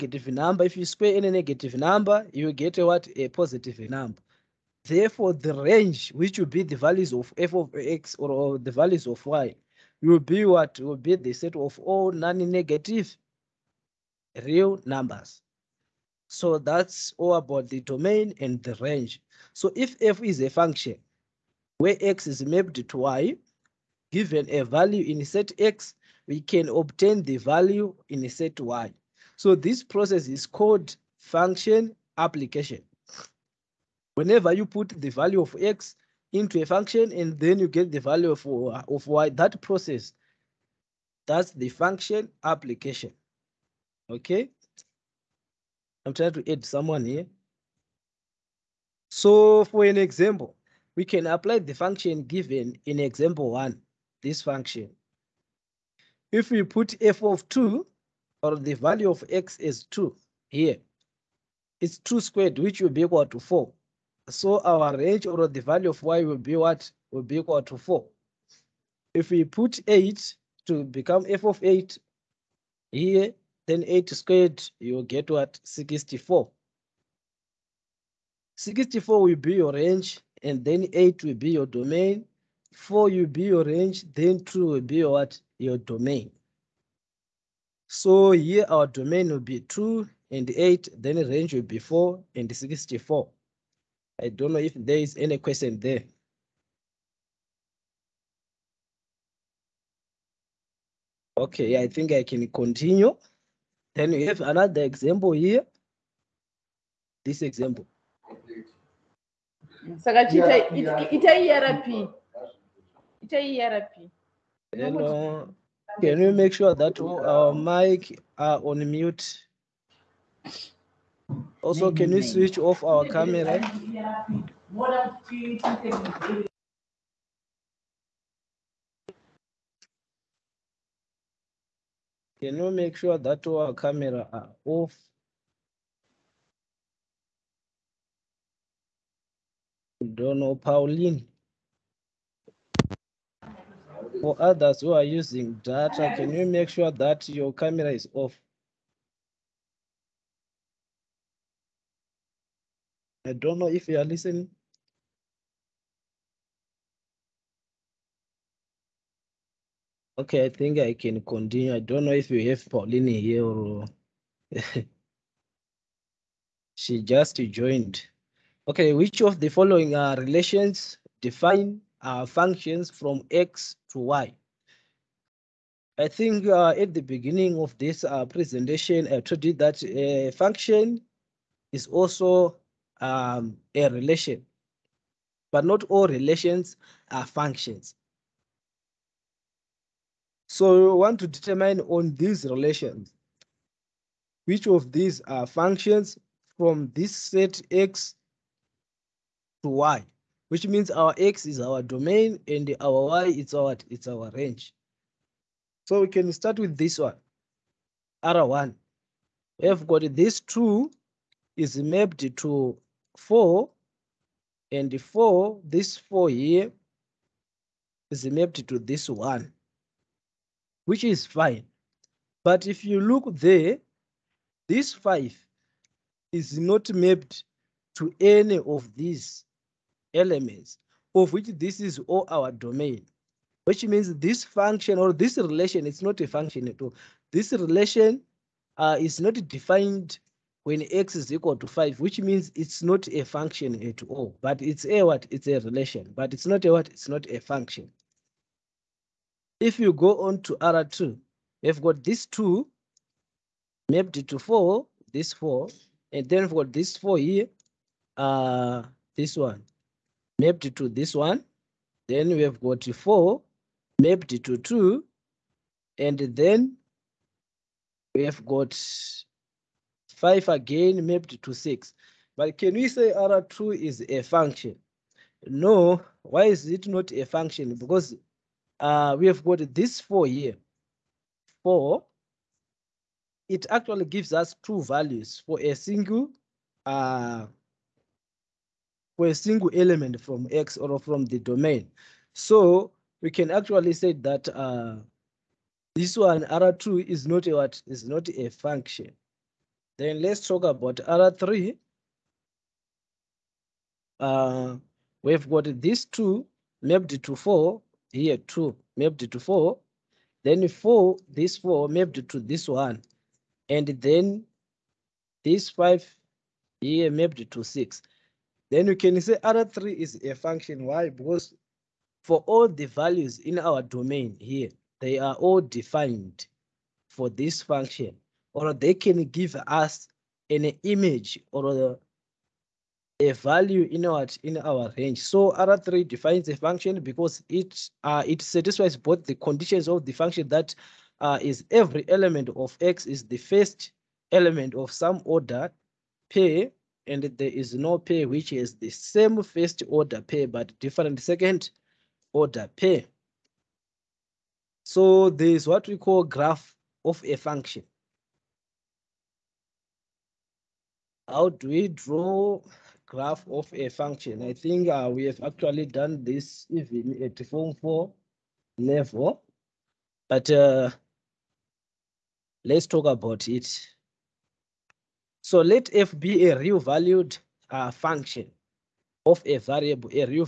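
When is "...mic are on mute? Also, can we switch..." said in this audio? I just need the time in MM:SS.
01:57.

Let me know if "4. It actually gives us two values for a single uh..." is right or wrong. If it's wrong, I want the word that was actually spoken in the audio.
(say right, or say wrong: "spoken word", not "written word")
right.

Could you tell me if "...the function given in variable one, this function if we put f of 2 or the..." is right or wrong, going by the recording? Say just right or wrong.
wrong.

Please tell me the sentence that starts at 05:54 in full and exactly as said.
So is what we call graph of a function.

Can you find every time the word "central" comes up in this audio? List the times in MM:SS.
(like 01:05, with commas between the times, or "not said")
not said.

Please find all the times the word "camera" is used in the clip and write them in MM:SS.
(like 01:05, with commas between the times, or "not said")
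02:03, 02:13, 02:27.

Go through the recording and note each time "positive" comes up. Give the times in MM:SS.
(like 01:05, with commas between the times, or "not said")
00:03.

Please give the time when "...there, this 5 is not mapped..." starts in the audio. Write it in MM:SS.
03:43.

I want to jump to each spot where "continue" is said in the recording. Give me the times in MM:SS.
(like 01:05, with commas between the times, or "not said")
01:42, 02:41.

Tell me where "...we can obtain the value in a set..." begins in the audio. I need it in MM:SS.
00:26.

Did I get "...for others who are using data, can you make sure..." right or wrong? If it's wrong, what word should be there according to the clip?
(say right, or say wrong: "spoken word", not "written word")
right.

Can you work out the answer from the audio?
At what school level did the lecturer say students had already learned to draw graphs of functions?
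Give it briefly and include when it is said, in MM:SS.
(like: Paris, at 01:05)
form 4, at 06:07.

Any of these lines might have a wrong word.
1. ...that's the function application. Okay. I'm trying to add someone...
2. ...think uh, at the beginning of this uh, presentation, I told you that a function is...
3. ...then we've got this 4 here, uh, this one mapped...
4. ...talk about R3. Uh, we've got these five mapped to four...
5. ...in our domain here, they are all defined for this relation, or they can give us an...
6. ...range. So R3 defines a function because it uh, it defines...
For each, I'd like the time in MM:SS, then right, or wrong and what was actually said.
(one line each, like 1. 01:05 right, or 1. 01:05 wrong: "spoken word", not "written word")
1. 00:41 right
2. 02:56 right
3. 04:16 right
4. 05:00 wrong: "two", not "five"
5. 05:23 wrong: "function", not "relation"
6. 05:34 wrong: "satisfies", not "defines".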